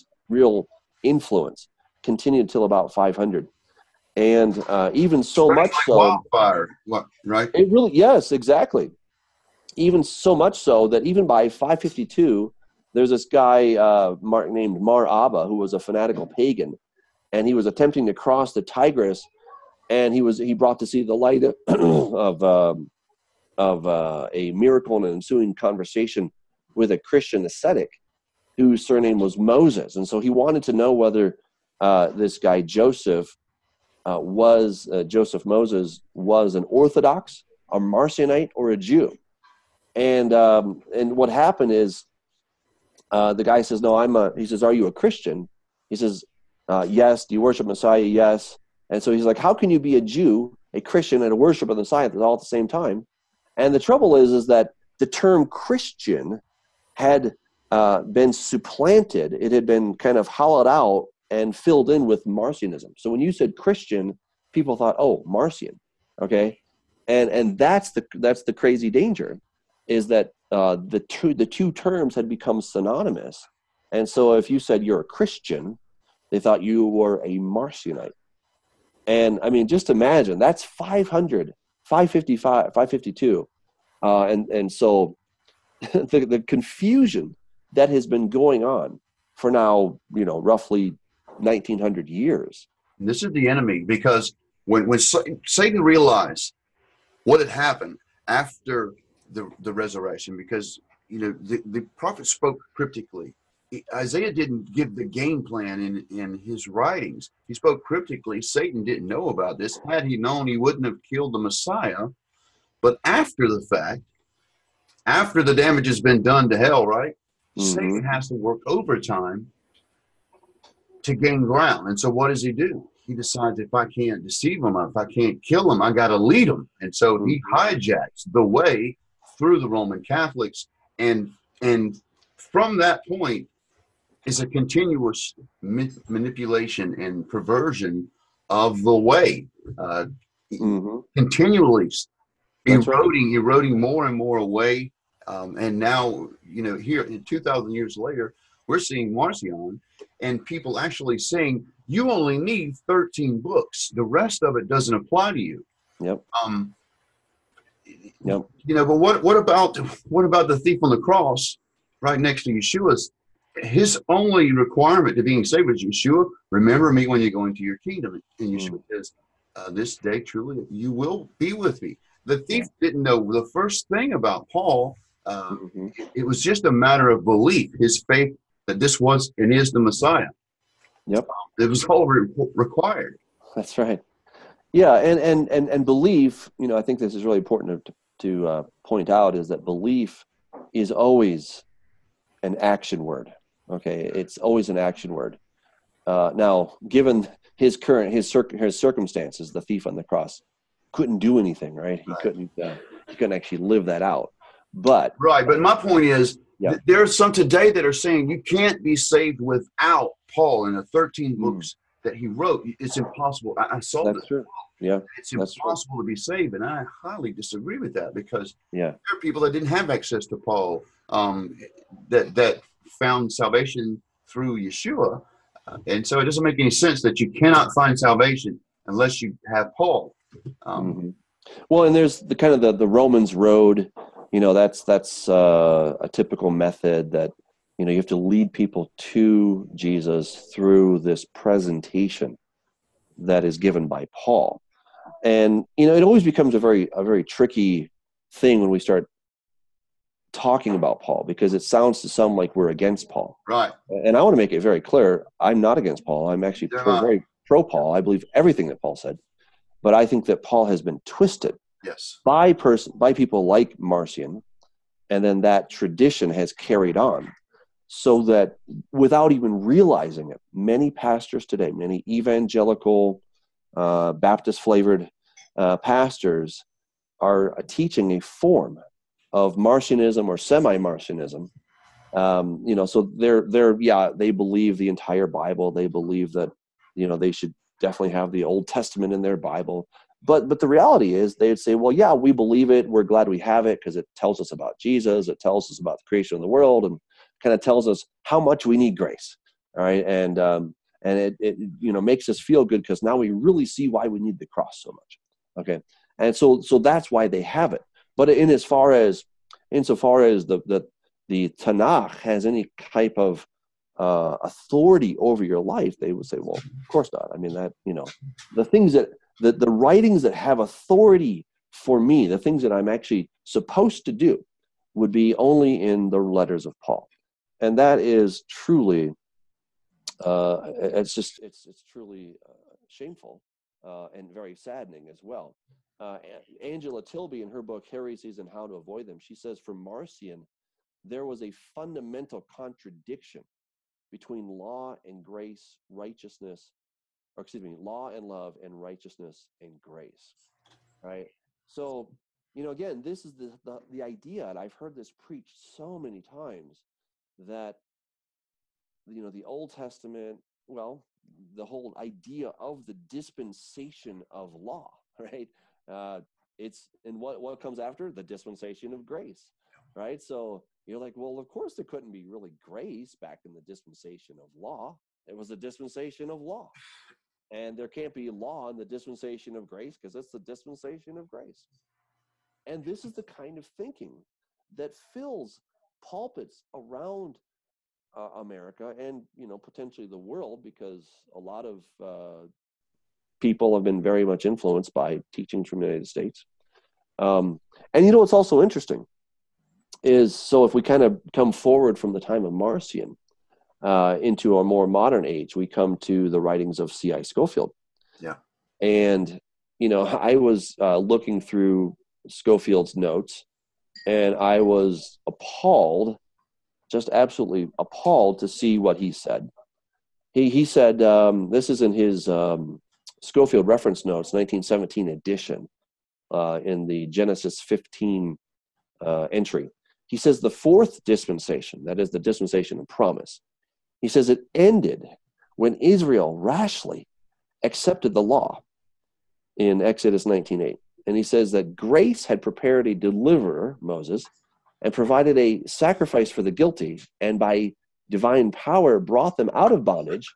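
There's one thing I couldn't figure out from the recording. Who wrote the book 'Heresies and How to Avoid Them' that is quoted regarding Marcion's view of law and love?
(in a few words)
Angela Tilby.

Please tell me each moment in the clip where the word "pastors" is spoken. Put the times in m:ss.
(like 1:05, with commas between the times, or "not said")
4:30, 4:35.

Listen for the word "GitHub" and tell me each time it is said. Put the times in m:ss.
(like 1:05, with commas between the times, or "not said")
not said.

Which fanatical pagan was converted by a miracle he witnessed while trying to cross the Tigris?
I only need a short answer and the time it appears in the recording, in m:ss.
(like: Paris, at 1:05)
Mar Abba, at 0:14.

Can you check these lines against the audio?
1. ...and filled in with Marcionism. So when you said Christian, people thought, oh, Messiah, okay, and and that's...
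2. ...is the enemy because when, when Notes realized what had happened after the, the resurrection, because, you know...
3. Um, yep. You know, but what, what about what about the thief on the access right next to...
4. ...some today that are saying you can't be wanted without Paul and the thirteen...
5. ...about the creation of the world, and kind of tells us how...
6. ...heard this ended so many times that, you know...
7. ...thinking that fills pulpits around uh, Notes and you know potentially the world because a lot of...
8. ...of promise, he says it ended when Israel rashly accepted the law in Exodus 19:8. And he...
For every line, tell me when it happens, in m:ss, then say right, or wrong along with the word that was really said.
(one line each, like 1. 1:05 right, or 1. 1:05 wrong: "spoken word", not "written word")
1. 1:01 wrong: "Marcion", not "Messiah"
2. 1:33 wrong: "Satan", not "Notes"
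3. 2:36 wrong: "cross", not "access"
4. 3:27 wrong: "saved", not "wanted"
5. 4:55 right
6. 5:54 wrong: "preached", not "ended"
7. 6:23 wrong: "America", not "Notes"
8. 7:12 right.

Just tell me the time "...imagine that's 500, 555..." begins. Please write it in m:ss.
1:19.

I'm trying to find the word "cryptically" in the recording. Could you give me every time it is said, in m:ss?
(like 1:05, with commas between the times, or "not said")
1:42, 1:47.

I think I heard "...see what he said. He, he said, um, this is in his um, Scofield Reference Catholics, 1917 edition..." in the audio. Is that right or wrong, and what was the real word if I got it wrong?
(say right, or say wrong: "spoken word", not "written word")
wrong: "Notes", not "Catholics".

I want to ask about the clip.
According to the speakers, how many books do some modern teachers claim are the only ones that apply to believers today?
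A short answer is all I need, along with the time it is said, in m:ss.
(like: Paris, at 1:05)
13, at 2:32.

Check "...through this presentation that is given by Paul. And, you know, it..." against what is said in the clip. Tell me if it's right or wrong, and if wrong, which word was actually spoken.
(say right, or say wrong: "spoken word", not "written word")
right.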